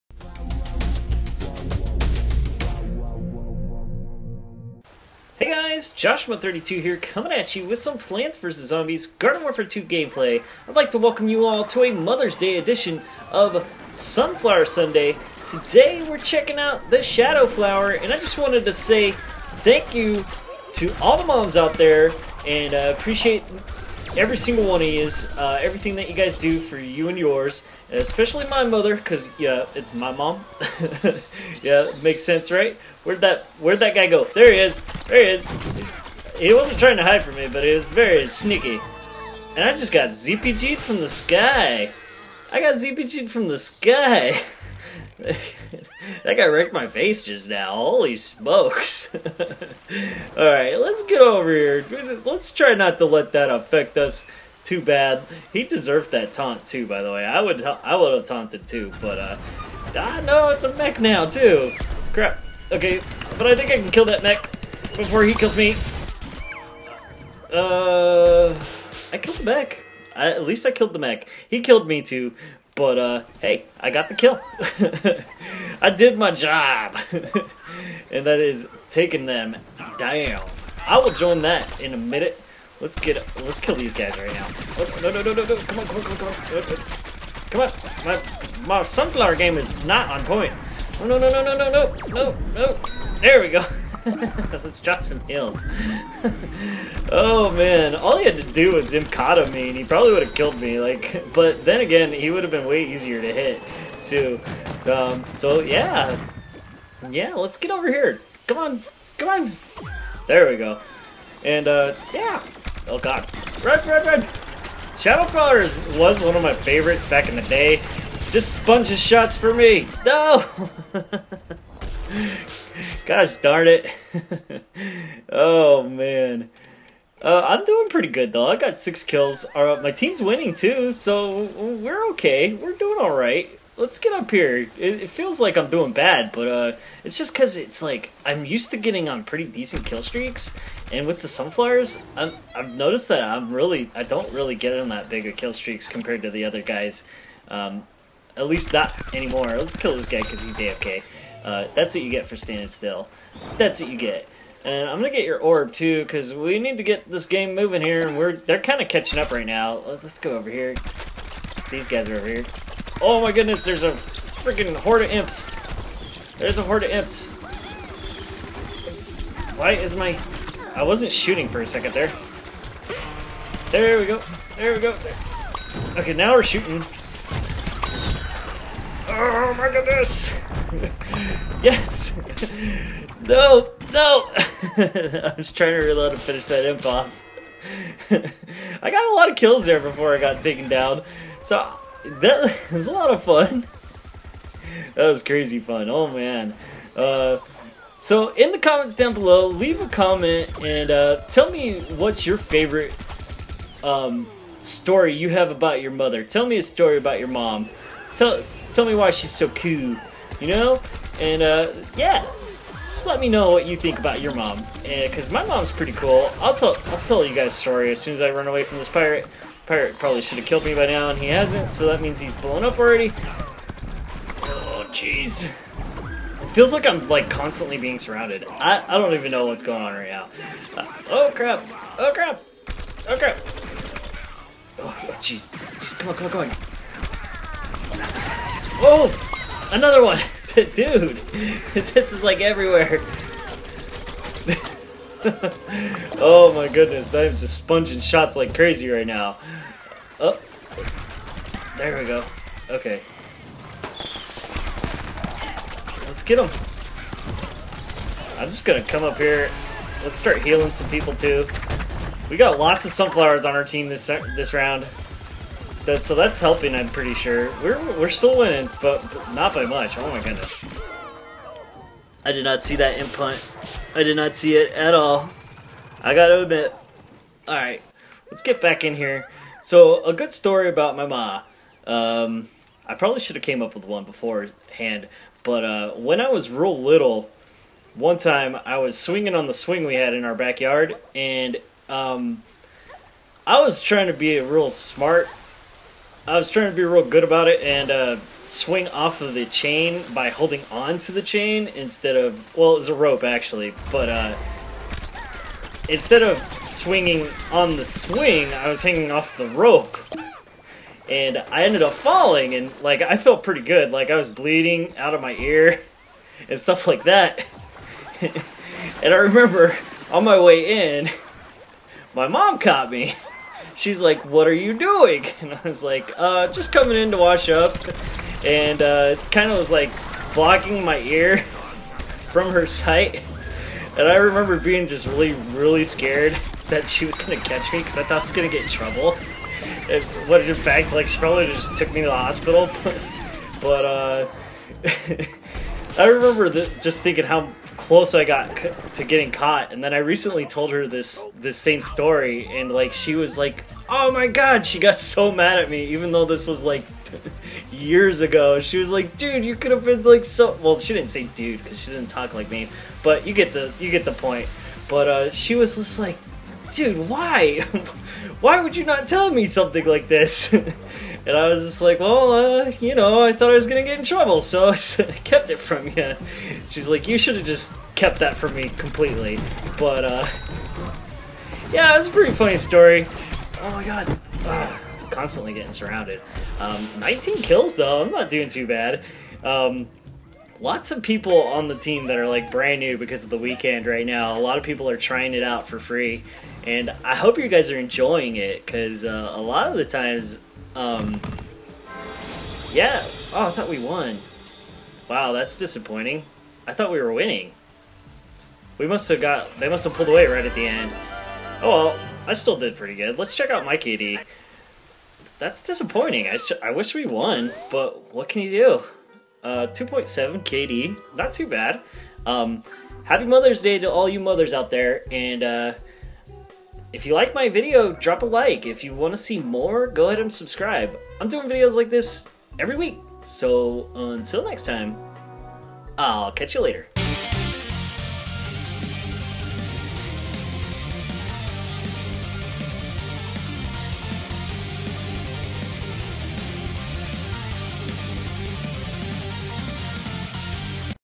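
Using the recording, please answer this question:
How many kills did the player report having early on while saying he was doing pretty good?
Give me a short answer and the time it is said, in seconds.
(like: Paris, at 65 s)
6, at 128 s.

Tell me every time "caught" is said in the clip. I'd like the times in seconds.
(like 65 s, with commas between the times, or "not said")
322 s, 349 s.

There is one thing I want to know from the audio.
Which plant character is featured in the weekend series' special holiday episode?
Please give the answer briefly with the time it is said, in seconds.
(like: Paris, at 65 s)
Shadow Flower, at 17 s.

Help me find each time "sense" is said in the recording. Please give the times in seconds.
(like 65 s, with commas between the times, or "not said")
32 s.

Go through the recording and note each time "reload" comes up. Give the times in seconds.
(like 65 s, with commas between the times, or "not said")
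185 s.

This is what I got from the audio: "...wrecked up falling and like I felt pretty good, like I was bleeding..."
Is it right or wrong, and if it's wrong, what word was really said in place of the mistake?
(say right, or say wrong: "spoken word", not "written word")
wrong: "ended", not "wrecked".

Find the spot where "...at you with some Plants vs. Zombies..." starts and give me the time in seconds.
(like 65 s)
7 s.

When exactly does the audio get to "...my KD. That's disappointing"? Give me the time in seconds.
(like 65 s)
413 s.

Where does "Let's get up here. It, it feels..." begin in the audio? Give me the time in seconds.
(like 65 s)
133 s.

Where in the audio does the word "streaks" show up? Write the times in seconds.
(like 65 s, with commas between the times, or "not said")
140 s, 145 s.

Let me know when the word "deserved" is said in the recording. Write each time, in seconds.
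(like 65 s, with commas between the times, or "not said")
55 s.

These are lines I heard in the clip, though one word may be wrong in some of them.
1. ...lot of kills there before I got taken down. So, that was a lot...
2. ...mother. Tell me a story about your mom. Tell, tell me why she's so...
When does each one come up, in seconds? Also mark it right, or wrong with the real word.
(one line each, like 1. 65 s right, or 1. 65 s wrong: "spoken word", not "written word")
1. 189 s right
2. 205 s right.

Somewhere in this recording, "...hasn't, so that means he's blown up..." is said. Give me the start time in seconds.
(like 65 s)
221 s.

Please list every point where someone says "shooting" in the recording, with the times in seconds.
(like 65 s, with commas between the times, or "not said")
171 s, 176 s.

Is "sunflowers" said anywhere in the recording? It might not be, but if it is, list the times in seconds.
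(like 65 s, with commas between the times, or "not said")
13 s, 88 s, 141 s, 262 s.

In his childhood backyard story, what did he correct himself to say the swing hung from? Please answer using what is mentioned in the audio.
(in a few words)
A rope.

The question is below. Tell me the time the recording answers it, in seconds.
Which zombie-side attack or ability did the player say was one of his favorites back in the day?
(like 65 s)
114 s.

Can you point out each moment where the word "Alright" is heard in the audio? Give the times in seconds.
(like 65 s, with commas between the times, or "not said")
50 s, 277 s.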